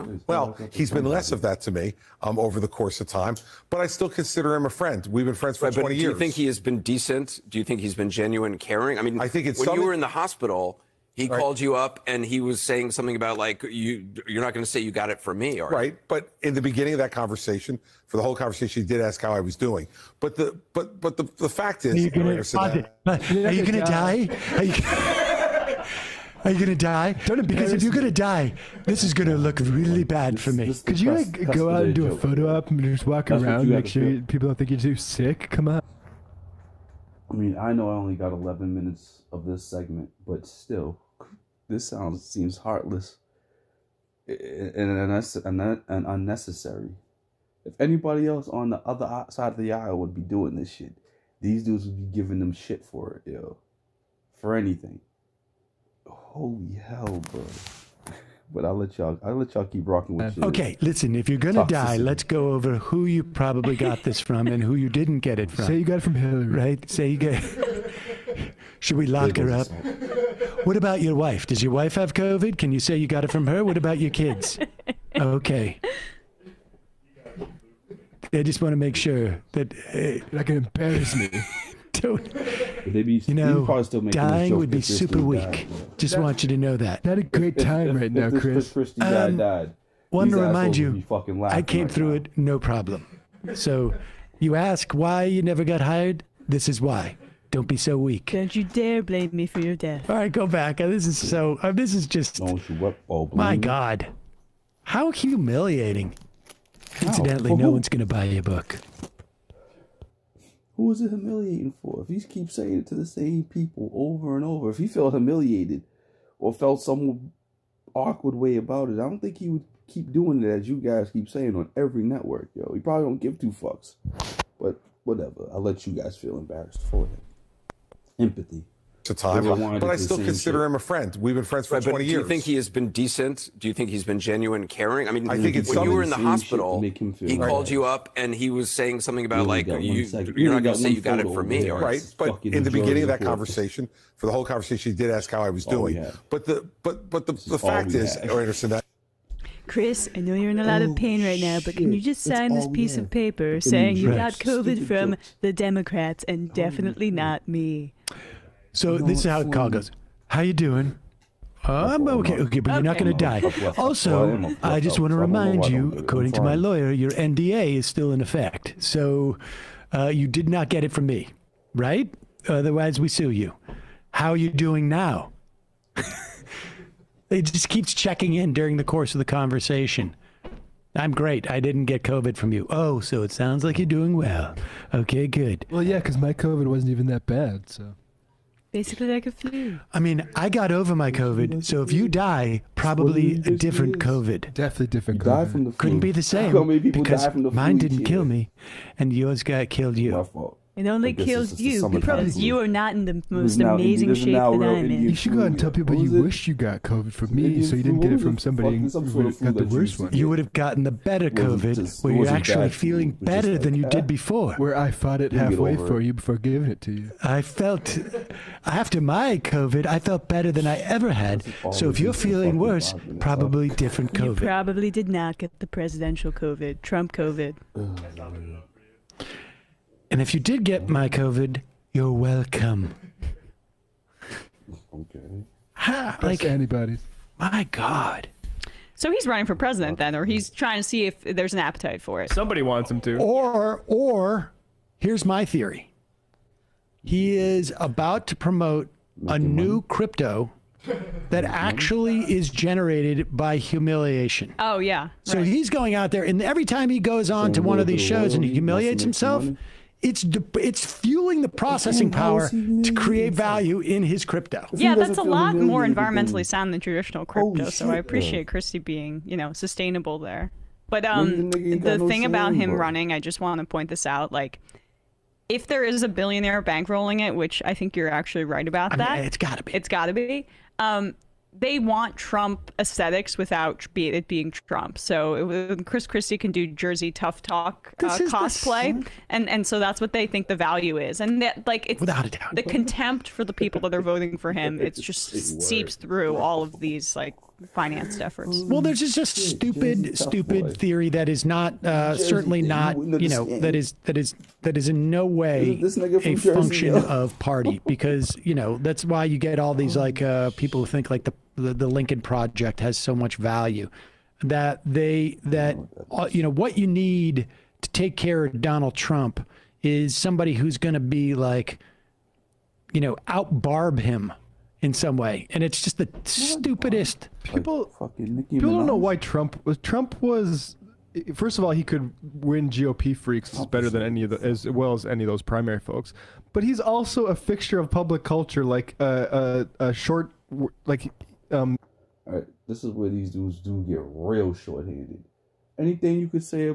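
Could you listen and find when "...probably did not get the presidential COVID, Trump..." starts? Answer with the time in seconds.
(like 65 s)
224 s.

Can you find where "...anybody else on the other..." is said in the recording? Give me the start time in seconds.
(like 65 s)
47 s.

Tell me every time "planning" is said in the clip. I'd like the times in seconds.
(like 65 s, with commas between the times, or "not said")
not said.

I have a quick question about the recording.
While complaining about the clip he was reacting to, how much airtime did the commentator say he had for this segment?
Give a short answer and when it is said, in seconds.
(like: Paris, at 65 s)
11 minutes, at 38 s.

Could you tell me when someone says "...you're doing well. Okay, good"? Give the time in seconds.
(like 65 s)
183 s.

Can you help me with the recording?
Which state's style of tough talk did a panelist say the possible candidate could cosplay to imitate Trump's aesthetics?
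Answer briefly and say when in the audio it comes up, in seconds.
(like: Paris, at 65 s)
Jersey, at 286 s.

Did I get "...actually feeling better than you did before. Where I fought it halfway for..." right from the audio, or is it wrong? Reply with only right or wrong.
right.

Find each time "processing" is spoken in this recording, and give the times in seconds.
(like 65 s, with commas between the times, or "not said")
261 s.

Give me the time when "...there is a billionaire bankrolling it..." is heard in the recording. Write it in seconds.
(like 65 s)
275 s.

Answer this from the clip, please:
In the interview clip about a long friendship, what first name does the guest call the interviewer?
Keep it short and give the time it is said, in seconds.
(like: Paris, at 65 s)
Anderson, at 148 s.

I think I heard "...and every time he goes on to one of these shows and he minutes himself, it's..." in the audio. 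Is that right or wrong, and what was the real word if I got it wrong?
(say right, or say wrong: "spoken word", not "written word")
wrong: "humiliates", not "minutes".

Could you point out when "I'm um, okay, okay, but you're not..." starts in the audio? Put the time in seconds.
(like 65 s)
161 s.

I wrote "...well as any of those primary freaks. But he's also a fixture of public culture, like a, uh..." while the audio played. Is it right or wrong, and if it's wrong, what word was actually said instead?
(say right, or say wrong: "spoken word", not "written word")
wrong: "folks", not "freaks".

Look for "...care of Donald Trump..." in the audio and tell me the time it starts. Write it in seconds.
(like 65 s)
318 s.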